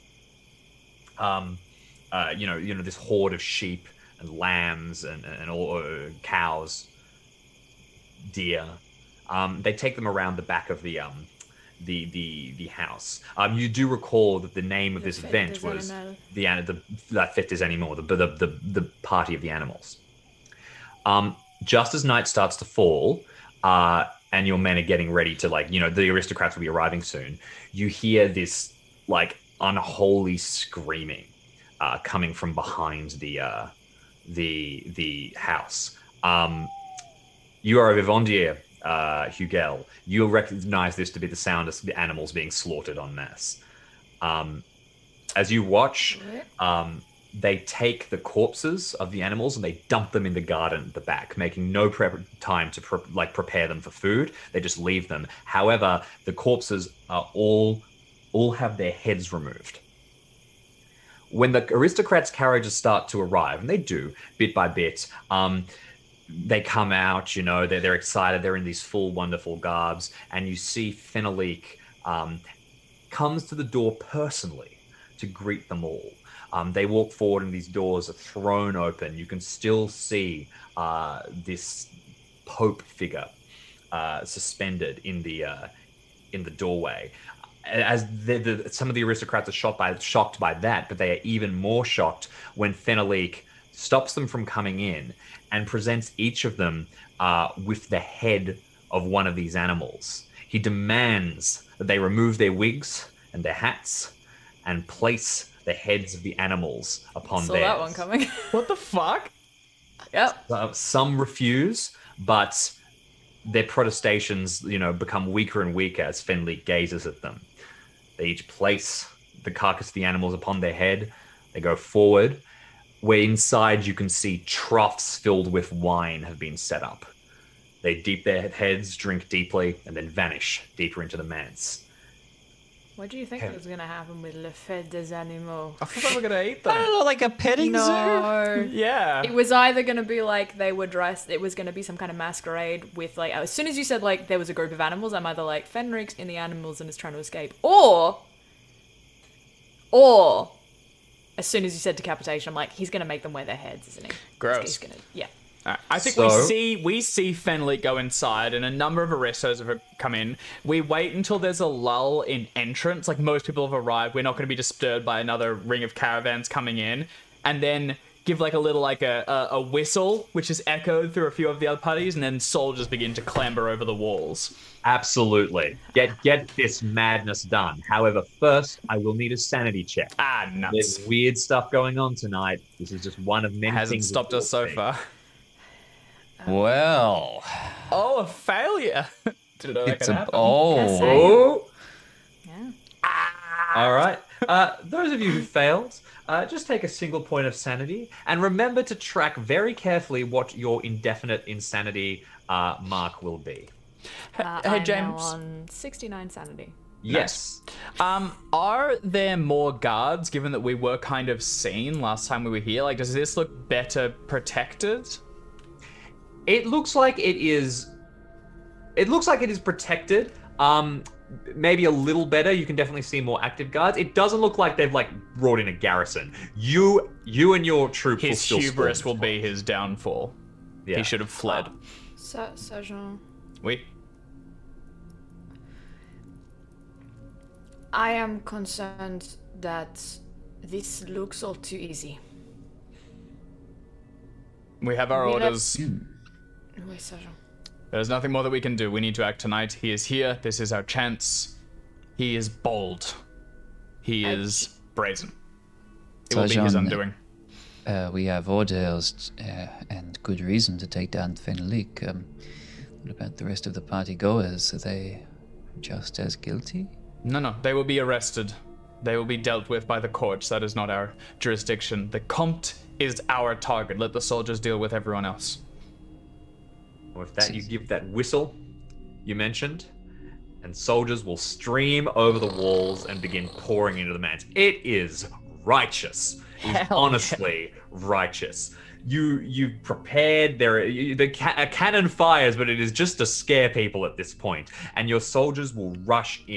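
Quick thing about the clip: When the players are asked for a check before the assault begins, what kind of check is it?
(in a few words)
Sanity check.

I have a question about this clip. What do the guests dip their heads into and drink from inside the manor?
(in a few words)
Troughs filled with wine.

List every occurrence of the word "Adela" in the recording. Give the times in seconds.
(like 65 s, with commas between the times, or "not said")
not said.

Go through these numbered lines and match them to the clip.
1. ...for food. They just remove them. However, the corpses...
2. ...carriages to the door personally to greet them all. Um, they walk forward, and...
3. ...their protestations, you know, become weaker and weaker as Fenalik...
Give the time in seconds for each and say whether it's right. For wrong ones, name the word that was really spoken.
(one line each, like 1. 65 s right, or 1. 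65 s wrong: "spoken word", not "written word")
1. 53 s wrong: "leave", not "remove"
2. 73 s wrong: "comes", not "carriages"
3. 113 s right.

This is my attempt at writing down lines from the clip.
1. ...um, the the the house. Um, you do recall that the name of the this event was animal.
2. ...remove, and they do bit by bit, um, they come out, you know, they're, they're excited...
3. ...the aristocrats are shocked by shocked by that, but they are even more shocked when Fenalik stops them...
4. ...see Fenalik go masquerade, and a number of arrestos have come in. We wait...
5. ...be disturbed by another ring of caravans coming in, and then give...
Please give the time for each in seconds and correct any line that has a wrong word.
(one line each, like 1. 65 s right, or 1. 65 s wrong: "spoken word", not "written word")
1. 10 s right
2. 63 s wrong: "arrive", not "remove"
3. 88 s right
4. 157 s wrong: "inside", not "masquerade"
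5. 164 s right.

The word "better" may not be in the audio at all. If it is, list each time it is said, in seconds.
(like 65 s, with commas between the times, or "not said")
213 s, 222 s.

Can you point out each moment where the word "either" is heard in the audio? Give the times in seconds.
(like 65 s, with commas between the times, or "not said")
139 s, 145 s.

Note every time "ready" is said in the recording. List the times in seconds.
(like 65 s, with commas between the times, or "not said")
25 s.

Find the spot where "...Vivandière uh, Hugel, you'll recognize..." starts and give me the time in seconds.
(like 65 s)
38 s.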